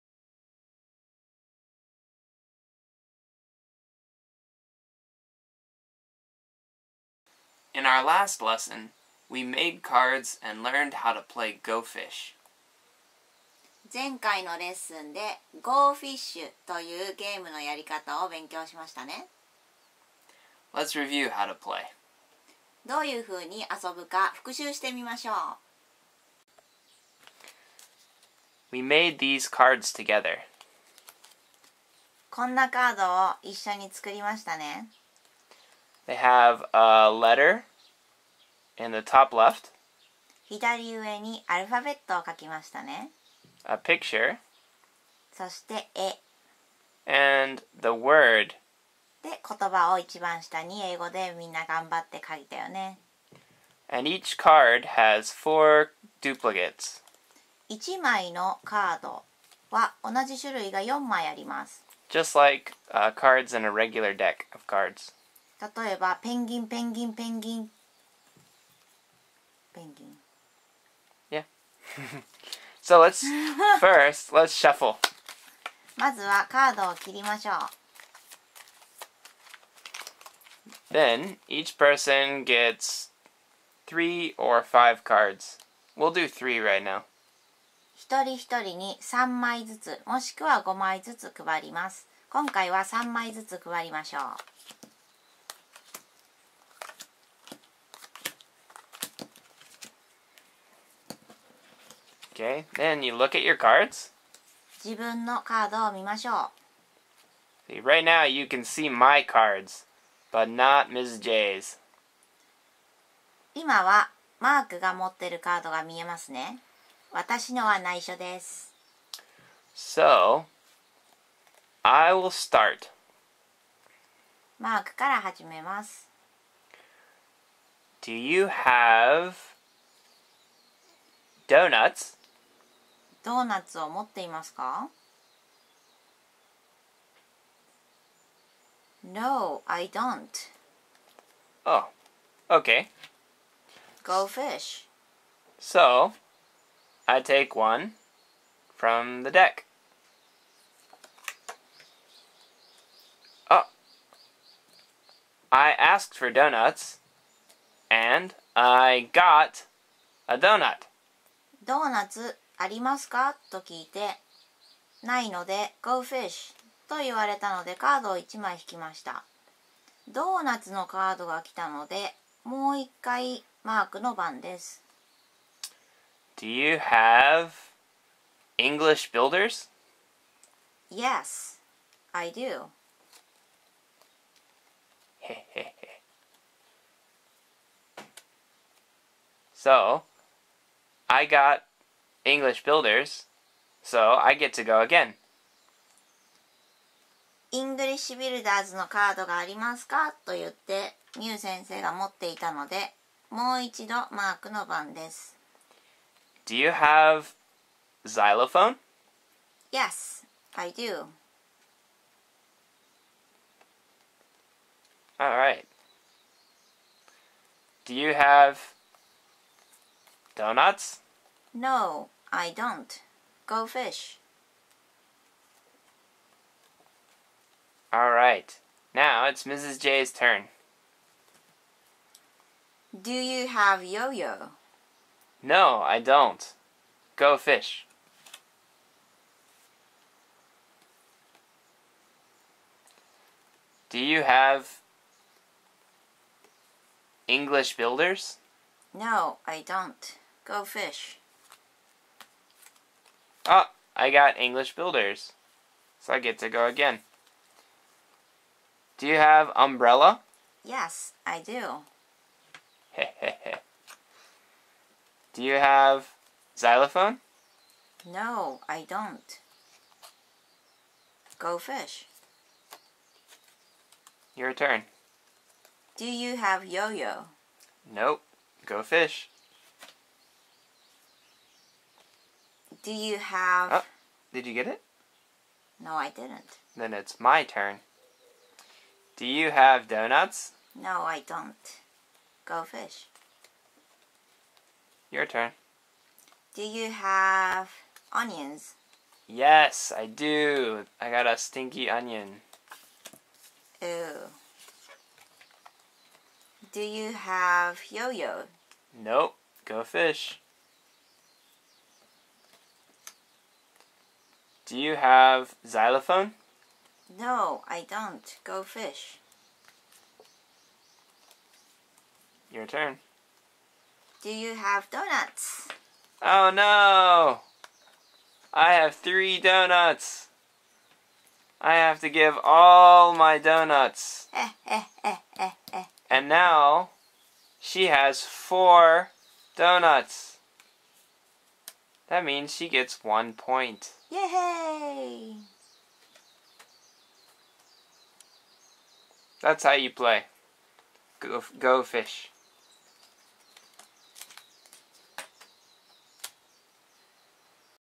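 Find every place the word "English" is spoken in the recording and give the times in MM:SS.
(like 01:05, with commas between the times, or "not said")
02:58, 03:12, 03:17, 04:07, 04:14.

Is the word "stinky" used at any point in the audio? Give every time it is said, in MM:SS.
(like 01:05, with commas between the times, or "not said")
05:01.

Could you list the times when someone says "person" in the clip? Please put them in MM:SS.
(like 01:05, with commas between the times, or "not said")
01:21.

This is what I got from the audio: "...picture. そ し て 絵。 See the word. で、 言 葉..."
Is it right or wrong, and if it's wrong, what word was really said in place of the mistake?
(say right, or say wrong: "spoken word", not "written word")
wrong: "And", not "See".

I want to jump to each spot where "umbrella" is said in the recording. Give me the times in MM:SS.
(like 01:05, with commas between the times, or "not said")
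04:19.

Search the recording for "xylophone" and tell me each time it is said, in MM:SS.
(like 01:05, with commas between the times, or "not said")
03:28, 04:26, 05:15.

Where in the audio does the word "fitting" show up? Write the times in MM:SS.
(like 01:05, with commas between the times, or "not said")
not said.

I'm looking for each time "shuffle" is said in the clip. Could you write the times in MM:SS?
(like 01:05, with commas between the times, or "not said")
01:14.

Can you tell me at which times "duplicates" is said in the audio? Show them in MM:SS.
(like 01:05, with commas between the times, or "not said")
00:56.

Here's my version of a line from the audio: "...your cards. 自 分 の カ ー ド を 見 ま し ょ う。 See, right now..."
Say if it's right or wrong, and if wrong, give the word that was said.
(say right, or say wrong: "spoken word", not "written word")
right.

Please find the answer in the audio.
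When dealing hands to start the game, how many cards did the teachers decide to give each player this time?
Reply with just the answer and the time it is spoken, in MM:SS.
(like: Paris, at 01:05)
3, at 01:25.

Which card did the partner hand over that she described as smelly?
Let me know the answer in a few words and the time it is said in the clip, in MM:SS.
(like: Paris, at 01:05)
Onions, at 05:00.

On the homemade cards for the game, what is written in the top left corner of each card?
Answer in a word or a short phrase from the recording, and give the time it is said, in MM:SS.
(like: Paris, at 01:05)
A letter, at 00:36.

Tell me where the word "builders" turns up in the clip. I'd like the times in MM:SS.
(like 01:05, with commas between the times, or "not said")
02:59, 03:12, 04:07, 04:14.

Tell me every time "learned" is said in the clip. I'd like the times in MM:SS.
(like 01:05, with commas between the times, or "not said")
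00:10.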